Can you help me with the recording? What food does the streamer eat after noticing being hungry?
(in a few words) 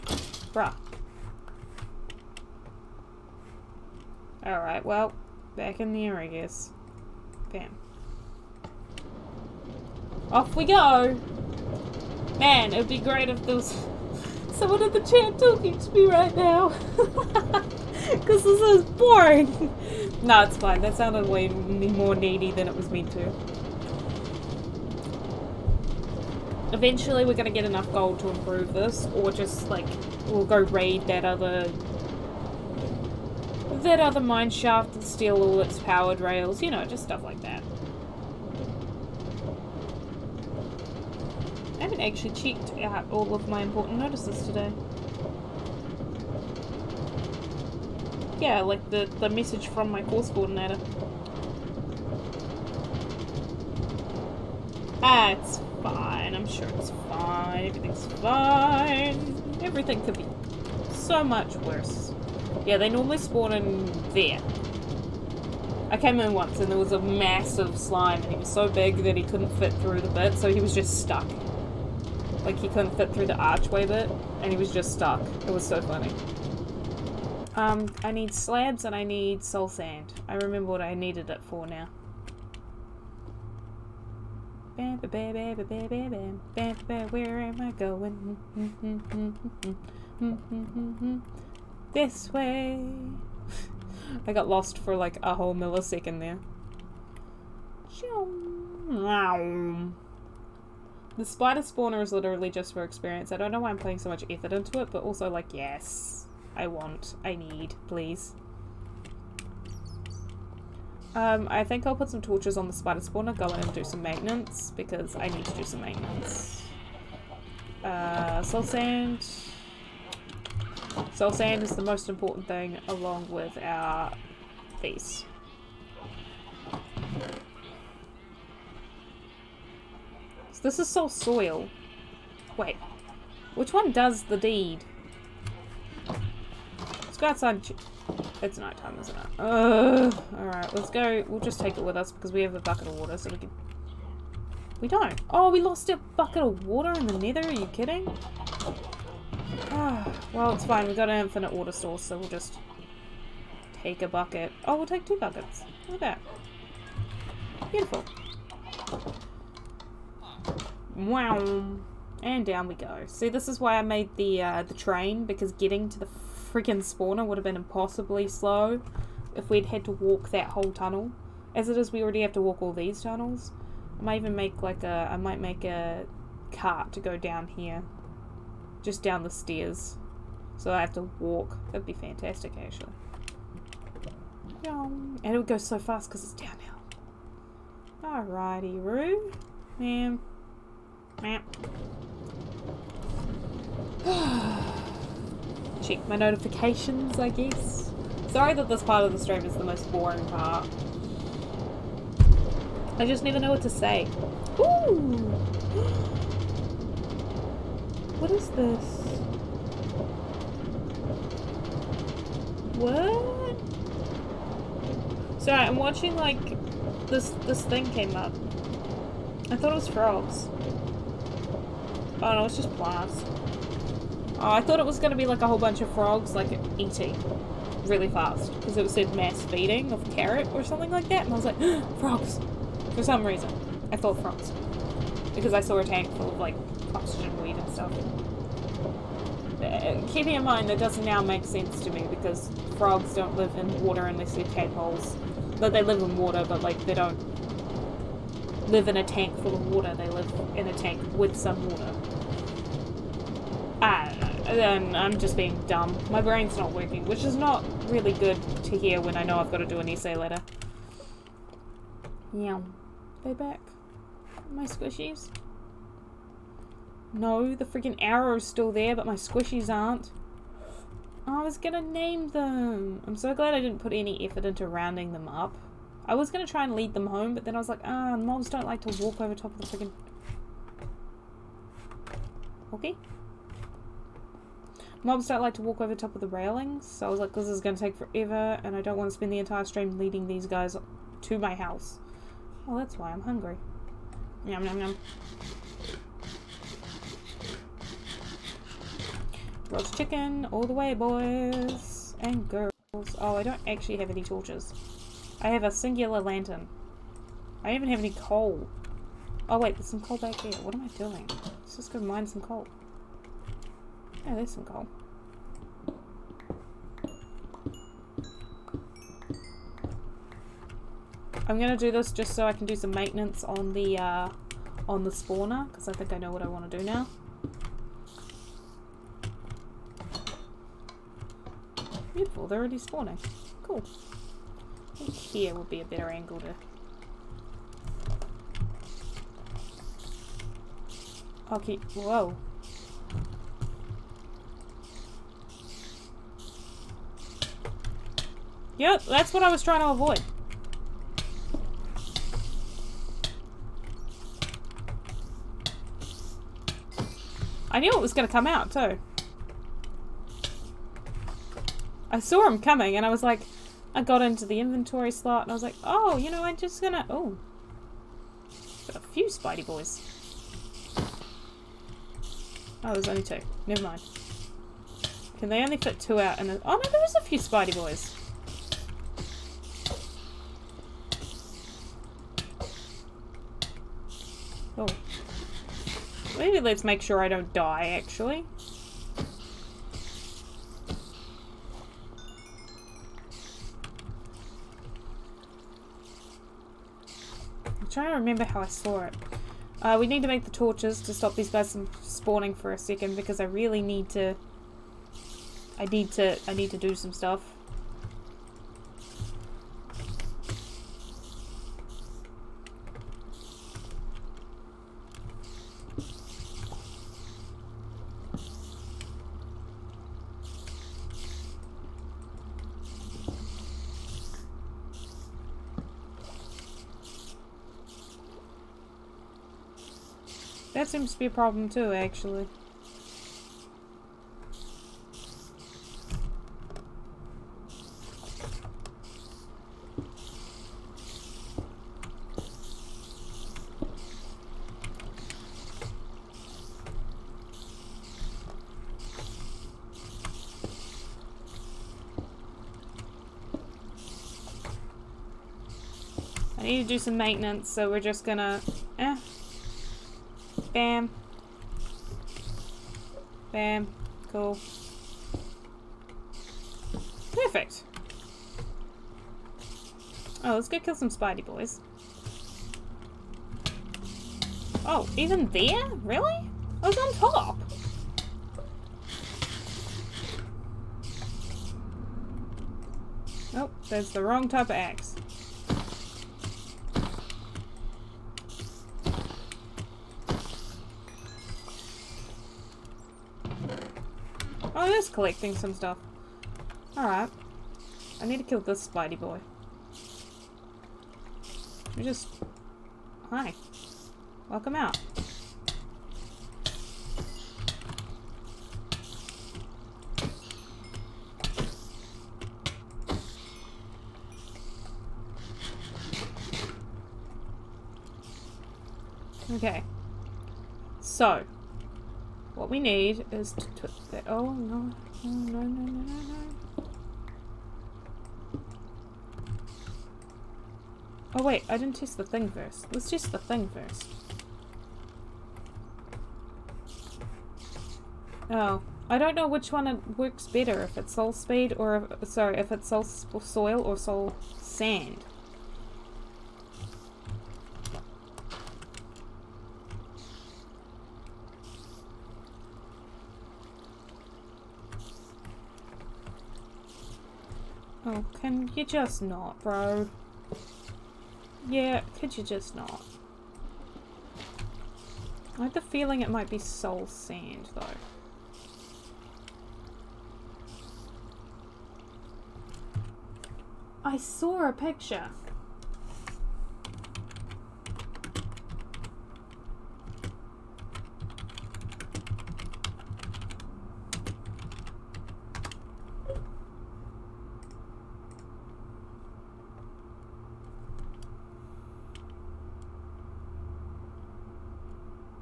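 Roast chicken.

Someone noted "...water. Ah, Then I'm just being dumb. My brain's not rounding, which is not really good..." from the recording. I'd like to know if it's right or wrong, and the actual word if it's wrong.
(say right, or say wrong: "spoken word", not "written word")
wrong: "working", not "rounding".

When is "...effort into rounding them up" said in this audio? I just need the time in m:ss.
4:34.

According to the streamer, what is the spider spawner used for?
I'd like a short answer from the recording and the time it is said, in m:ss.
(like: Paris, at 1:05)
Experience, at 1:42.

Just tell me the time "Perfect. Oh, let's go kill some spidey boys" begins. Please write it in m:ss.
7:47.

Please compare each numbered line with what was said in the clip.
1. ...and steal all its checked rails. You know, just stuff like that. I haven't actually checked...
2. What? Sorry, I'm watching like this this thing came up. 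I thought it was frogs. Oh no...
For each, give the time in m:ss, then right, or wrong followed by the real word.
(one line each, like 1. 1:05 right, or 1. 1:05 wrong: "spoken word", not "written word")
1. 0:34 wrong: "powered", not "checked"
2. 3:32 right.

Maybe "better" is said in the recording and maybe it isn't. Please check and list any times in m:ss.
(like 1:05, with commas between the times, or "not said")
5:35, 9:00.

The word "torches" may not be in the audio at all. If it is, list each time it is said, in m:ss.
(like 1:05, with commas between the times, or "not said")
1:52, 5:04, 6:40.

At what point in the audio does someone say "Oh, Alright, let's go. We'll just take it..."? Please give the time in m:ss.
2:19.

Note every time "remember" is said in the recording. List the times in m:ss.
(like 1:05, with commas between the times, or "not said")
1:20, 6:38.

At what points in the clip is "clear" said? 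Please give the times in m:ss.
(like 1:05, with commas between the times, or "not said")
not said.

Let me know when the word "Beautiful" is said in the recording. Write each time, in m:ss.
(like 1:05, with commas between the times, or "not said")
2:37, 5:32.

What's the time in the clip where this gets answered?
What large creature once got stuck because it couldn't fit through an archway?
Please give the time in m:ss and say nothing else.
1:06.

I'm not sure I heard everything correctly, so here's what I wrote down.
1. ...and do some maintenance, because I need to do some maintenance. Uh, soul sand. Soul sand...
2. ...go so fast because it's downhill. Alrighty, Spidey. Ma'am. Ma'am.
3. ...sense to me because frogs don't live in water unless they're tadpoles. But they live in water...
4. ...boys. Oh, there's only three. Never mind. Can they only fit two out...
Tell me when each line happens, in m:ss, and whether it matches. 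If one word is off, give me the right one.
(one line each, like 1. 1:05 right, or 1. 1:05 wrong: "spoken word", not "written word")
1. 1:53 right
2. 3:05 wrong: "Roo", not "Spidey"
3. 4:01 right
4. 6:09 wrong: "two", not "three".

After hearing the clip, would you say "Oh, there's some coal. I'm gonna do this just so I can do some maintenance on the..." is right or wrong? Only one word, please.
right.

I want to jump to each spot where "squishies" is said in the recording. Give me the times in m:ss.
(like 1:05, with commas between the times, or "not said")
4:24, 4:29.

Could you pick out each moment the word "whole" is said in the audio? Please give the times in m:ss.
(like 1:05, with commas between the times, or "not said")
1:35, 2:50, 3:45.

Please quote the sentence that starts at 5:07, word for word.
I don't even have any coal.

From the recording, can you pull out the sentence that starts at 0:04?
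Alright, well, back in there, I guess.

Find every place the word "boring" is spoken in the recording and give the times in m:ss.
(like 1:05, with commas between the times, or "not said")
0:18, 3:19.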